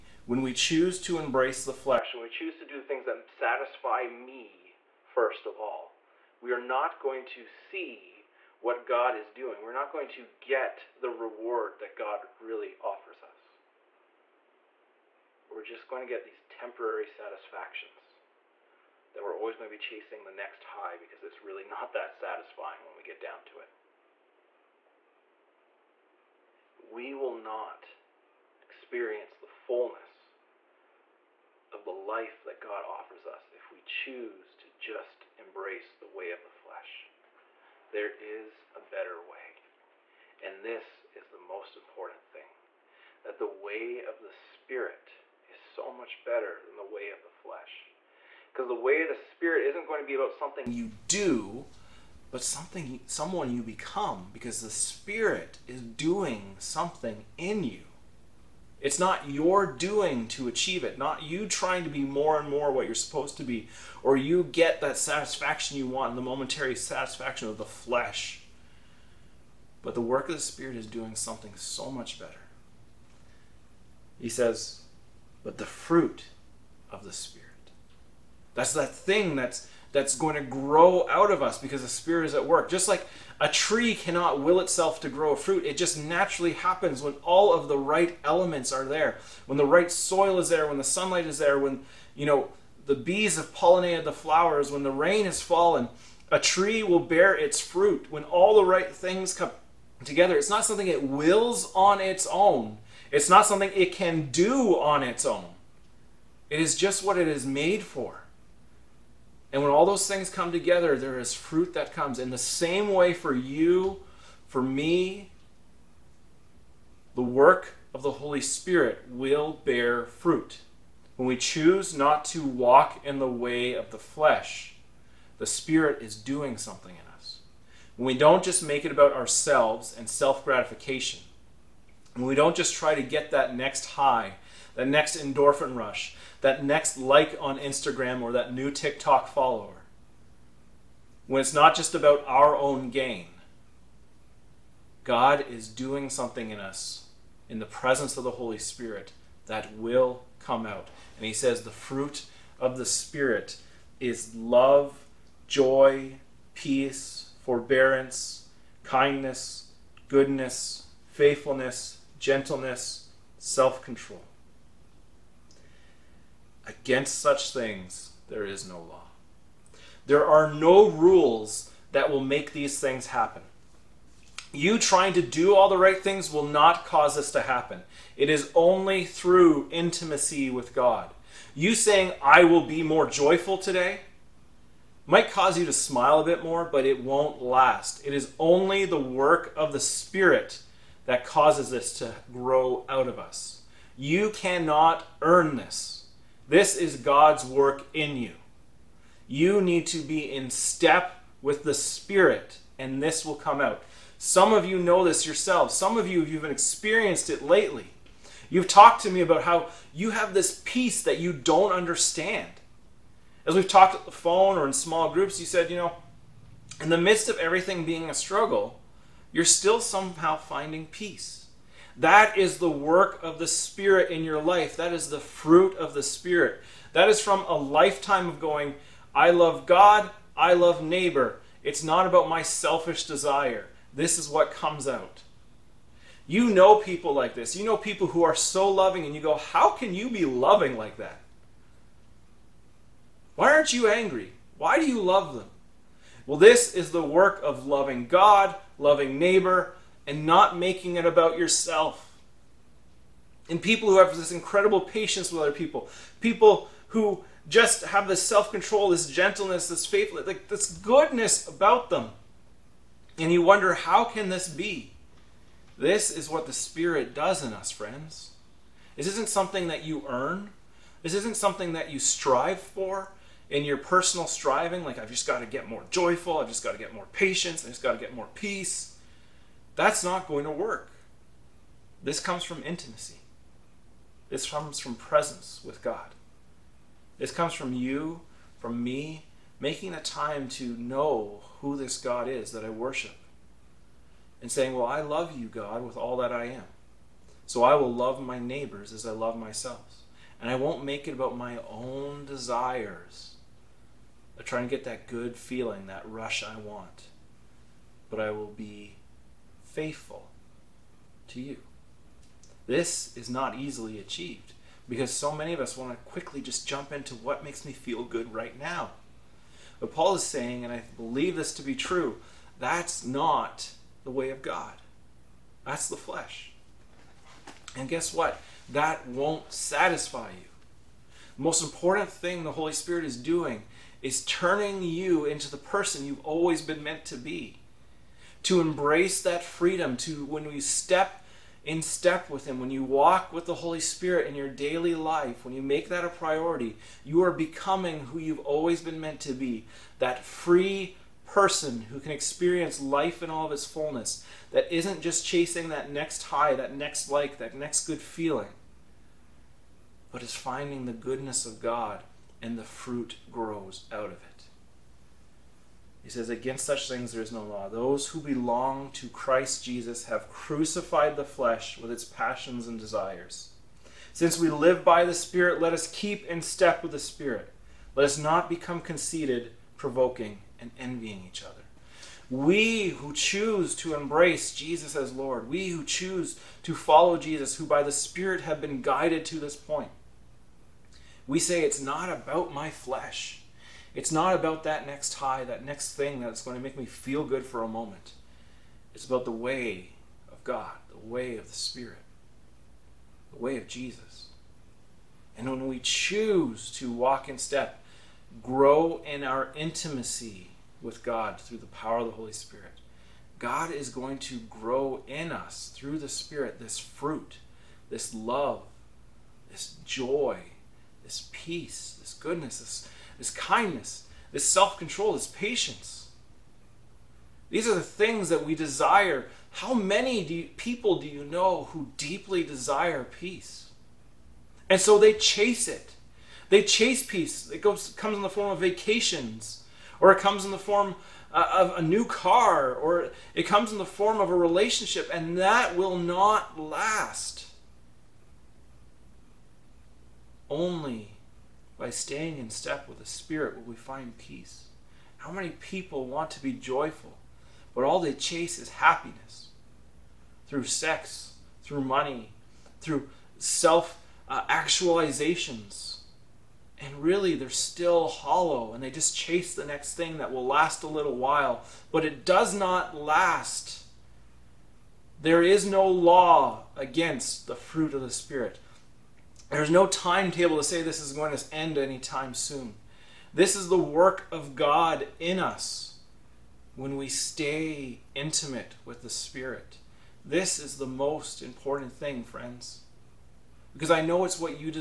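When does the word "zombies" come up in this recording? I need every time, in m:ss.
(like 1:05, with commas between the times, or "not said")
not said.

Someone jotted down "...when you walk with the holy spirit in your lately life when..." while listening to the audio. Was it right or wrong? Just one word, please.
wrong.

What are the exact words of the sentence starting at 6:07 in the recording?
Those who belong to Christ Jesus have crucified the flesh with its passions and desires.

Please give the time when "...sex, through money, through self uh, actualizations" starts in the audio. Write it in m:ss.
7:40.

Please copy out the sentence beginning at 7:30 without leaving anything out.
Only by staying in step with the Spirit will we find peace.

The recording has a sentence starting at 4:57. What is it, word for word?
So I will love my neighbors as I love myself.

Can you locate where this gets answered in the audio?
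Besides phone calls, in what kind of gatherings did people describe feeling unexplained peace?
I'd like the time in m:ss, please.
3:34.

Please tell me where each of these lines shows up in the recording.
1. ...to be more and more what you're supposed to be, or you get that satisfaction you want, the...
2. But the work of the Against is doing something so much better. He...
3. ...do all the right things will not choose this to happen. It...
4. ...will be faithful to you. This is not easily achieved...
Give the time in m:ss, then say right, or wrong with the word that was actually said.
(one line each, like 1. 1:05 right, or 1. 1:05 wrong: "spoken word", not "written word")
1. 1:01 right
2. 1:09 wrong: "Spirit", not "Against"
3. 2:55 wrong: "cause", not "choose"
4. 5:08 right.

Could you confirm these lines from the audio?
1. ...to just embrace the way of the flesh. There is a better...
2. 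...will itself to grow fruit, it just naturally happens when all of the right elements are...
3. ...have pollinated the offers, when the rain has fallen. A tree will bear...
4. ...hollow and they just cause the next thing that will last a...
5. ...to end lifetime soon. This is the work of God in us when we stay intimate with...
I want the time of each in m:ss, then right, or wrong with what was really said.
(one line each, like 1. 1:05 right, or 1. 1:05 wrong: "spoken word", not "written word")
1. 0:34 right
2. 1:24 right
3. 1:33 wrong: "flowers", not "offers"
4. 7:48 wrong: "chase", not "cause"
5. 8:01 wrong: "anytime", not "lifetime".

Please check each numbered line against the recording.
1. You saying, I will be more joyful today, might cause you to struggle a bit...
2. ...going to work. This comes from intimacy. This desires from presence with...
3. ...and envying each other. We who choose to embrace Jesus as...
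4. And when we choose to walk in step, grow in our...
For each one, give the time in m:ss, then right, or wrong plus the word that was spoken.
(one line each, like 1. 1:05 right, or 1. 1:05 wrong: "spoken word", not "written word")
1. 3:01 wrong: "smile", not "struggle"
2. 4:40 wrong: "comes", not "desires"
3. 6:20 right
4. 6:45 right.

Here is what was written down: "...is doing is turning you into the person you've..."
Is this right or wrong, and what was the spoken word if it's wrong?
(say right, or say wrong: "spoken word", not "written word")
right.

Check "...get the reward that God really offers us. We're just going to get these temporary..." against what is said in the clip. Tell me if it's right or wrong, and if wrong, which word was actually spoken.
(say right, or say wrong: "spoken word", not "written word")
right.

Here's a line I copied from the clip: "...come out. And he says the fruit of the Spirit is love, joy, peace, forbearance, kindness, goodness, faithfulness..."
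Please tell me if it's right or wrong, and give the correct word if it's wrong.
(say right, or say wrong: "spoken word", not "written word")
right.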